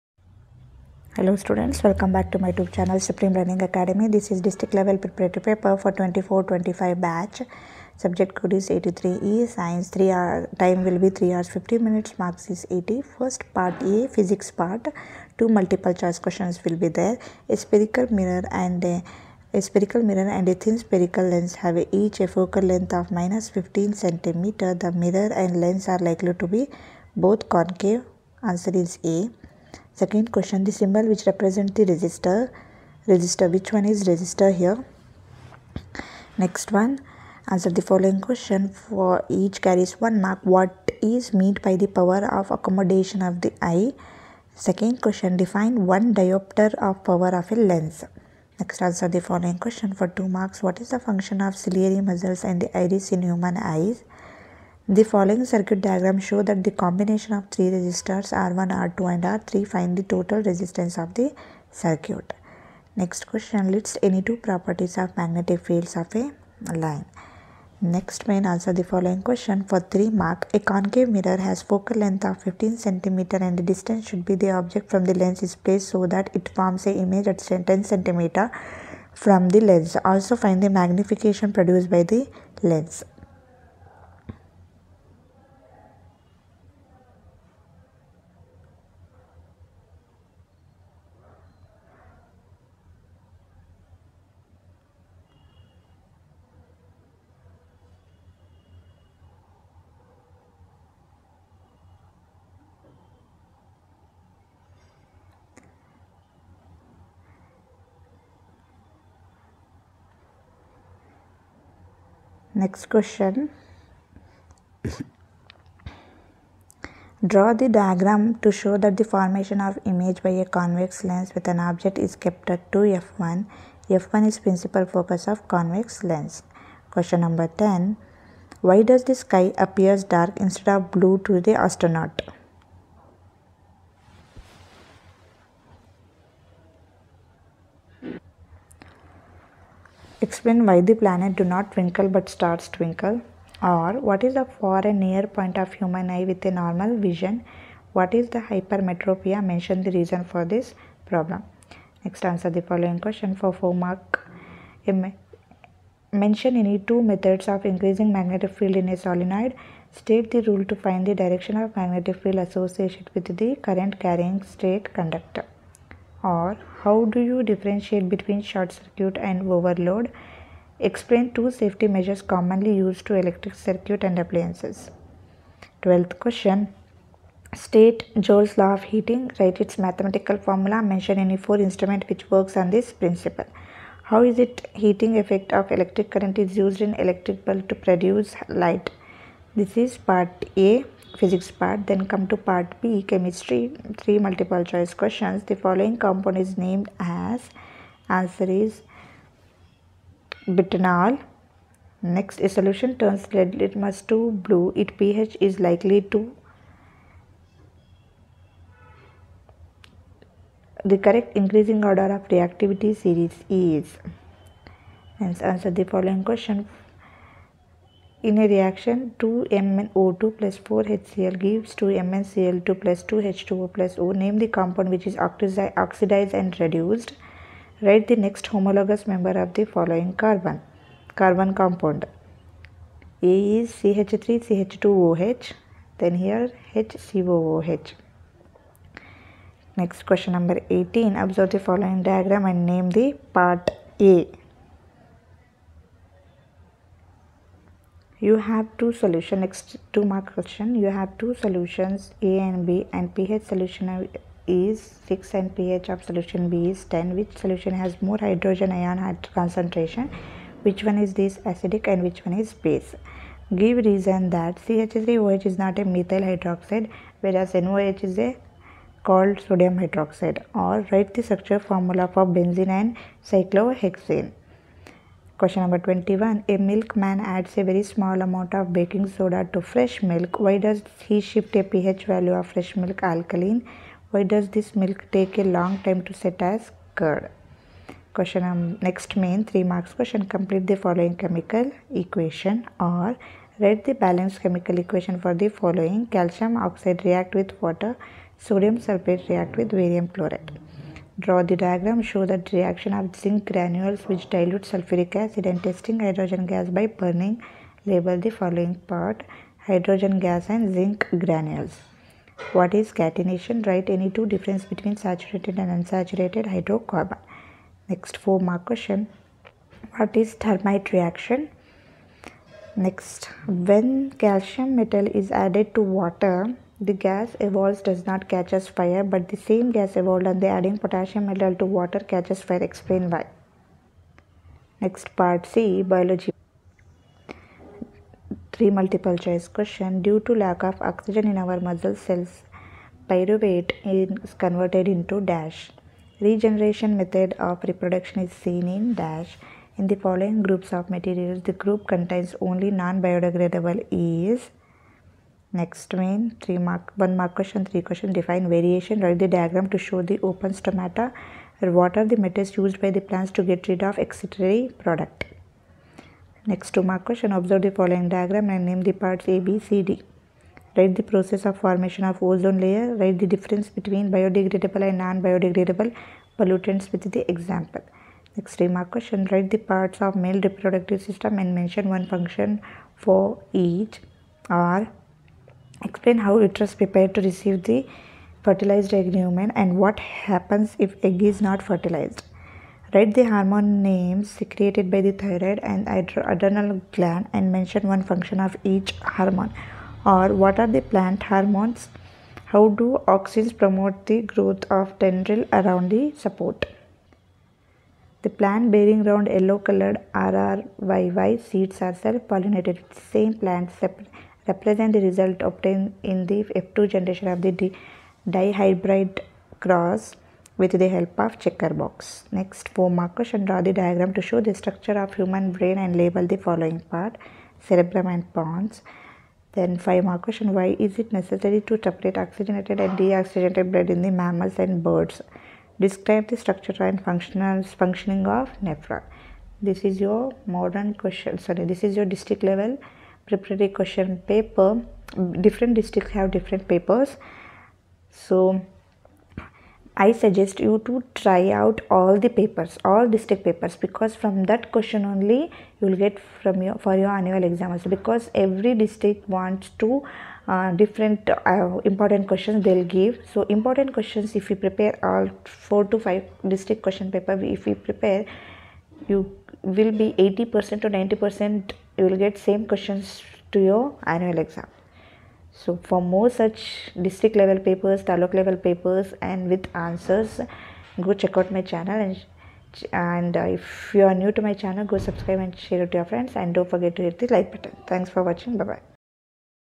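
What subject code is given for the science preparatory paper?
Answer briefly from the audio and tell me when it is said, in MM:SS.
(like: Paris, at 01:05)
83E, at 00:08.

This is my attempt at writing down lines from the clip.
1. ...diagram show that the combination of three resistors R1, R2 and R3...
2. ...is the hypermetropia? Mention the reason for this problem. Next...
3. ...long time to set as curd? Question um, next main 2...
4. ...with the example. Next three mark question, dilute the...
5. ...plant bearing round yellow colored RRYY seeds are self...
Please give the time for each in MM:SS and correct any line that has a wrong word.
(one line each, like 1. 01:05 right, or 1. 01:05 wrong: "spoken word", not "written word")
1. 00:55 right
2. 02:28 right
3. 04:45 wrong: "3", not "2"
4. 06:16 wrong: "write", not "dilute"
5. 06:48 right.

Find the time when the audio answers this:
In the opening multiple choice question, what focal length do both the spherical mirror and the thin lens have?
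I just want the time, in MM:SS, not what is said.
00:23.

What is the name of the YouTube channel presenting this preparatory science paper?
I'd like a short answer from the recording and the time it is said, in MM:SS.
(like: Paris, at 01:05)
Supreme Learning Academy, at 00:02.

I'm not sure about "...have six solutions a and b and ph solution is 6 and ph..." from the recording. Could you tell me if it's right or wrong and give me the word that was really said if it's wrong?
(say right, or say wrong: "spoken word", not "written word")
wrong: "two", not "six".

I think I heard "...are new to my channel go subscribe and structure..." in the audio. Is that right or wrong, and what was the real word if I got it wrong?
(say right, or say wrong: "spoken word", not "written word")
wrong: "share", not "structure".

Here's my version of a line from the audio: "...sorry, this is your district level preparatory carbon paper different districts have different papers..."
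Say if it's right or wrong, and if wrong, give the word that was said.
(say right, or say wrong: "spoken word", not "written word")
wrong: "question", not "carbon".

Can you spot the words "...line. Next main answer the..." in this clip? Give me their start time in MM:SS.
01:06.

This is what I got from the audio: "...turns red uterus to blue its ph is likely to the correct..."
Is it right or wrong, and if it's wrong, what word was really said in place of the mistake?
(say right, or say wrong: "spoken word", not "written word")
wrong: "litmus", not "uterus".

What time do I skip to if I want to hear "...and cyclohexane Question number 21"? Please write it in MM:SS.
04:32.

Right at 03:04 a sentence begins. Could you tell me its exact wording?
How is it heating effect of electric current is used in electric bulb to produce light?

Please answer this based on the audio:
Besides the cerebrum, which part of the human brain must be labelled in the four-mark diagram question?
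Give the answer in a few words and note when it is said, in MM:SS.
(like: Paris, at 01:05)
Pons, at 07:08.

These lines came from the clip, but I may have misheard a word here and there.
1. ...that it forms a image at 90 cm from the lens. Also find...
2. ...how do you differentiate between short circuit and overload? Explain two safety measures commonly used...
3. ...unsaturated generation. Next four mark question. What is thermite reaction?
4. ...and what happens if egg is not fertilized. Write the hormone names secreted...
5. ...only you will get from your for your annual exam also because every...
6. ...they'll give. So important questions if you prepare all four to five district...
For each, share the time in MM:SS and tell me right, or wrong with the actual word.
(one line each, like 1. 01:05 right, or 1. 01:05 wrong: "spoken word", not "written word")
1. 01:16 wrong: "10", not "90"
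2. 02:46 right
3. 05:15 wrong: "hydrocarbon", not "generation"
4. 06:29 right
5. 07:35 right
6. 07:42 right.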